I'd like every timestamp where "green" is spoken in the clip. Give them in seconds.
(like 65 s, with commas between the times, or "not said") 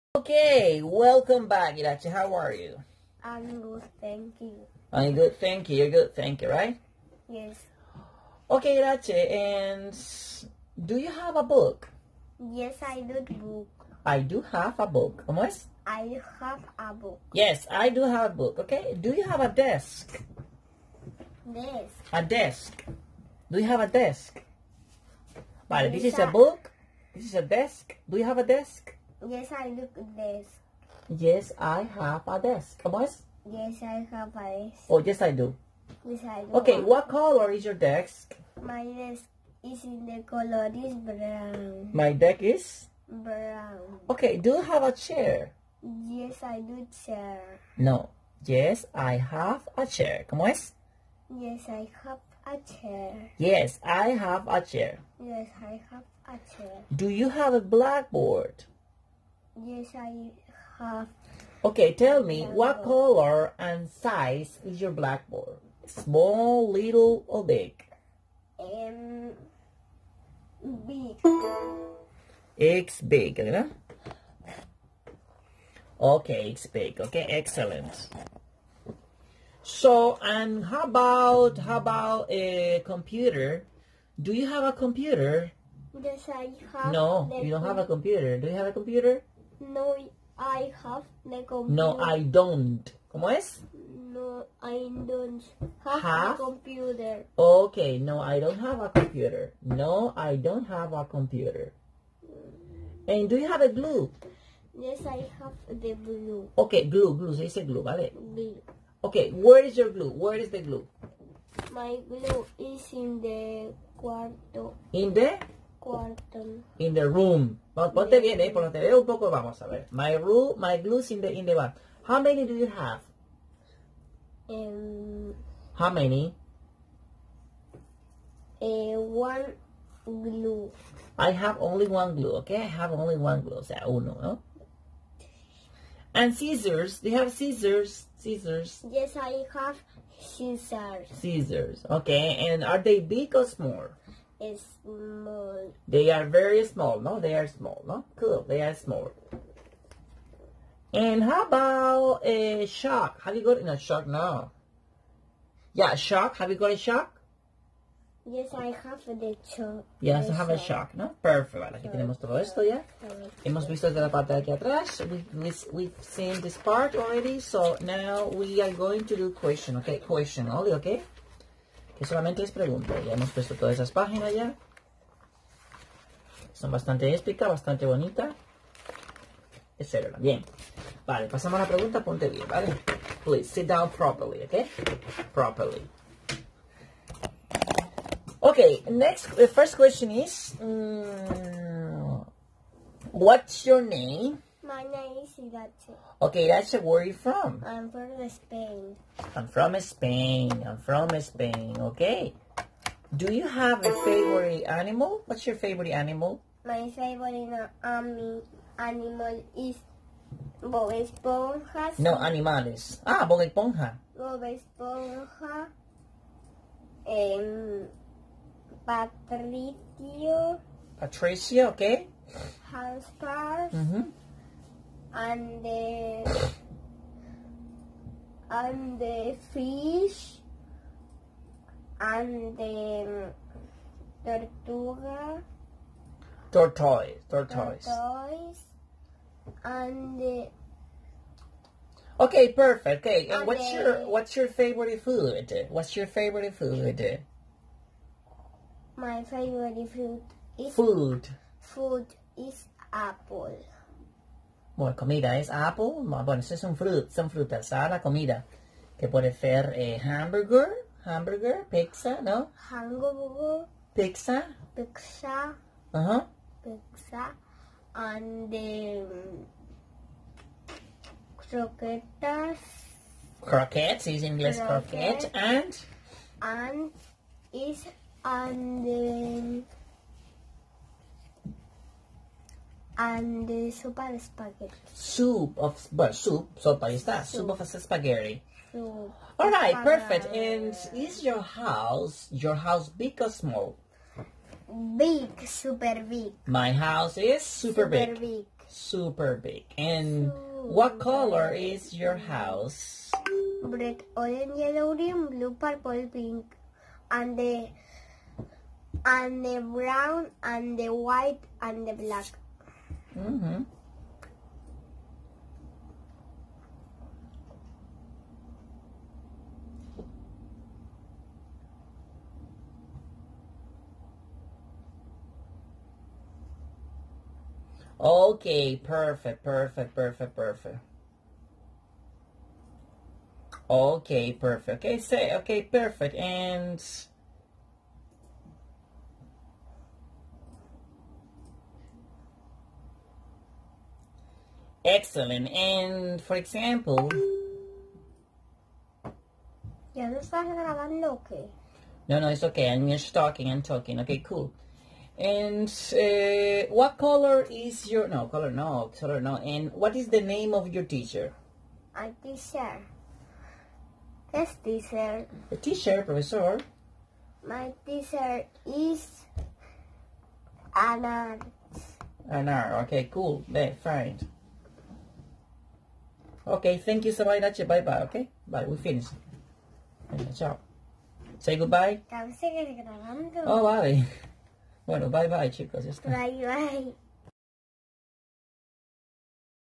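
304 s.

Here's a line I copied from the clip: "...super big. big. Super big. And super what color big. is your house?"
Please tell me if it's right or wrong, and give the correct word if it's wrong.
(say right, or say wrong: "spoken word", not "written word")
right.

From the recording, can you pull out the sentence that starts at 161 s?
Vale, aquí tenemos todo esto ya.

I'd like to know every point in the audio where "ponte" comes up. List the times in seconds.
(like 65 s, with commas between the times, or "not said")
117 s, 182 s.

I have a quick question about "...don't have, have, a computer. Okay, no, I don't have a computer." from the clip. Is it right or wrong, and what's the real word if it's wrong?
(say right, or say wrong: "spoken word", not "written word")
right.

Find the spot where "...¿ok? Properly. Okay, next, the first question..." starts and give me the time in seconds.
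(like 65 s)
184 s.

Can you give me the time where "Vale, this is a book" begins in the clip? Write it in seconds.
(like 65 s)
25 s.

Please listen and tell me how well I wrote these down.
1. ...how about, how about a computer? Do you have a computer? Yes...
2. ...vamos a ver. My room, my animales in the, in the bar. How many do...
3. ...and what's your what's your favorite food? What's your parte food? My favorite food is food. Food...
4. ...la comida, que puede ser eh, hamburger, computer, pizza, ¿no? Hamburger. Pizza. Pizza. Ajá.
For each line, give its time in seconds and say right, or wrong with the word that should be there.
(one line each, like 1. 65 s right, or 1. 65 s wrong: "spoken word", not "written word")
1. 80 s right
2. 119 s wrong: "glues", not "animales"
3. 243 s wrong: "favorite", not "parte"
4. 257 s wrong: "hamburger", not "computer".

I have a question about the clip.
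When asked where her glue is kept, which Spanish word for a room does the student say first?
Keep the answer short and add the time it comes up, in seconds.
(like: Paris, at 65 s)
cuarto, at 113 s.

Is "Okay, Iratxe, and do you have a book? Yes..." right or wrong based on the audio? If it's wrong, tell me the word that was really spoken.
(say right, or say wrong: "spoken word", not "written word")
right.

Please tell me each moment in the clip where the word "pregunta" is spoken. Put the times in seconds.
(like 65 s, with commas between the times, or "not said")
172 s, 181 s.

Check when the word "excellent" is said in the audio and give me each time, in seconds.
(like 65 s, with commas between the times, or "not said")
77 s, 344 s.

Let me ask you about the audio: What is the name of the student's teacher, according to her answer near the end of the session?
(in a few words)
Anna.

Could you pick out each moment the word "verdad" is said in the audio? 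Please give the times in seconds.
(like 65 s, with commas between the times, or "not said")
73 s.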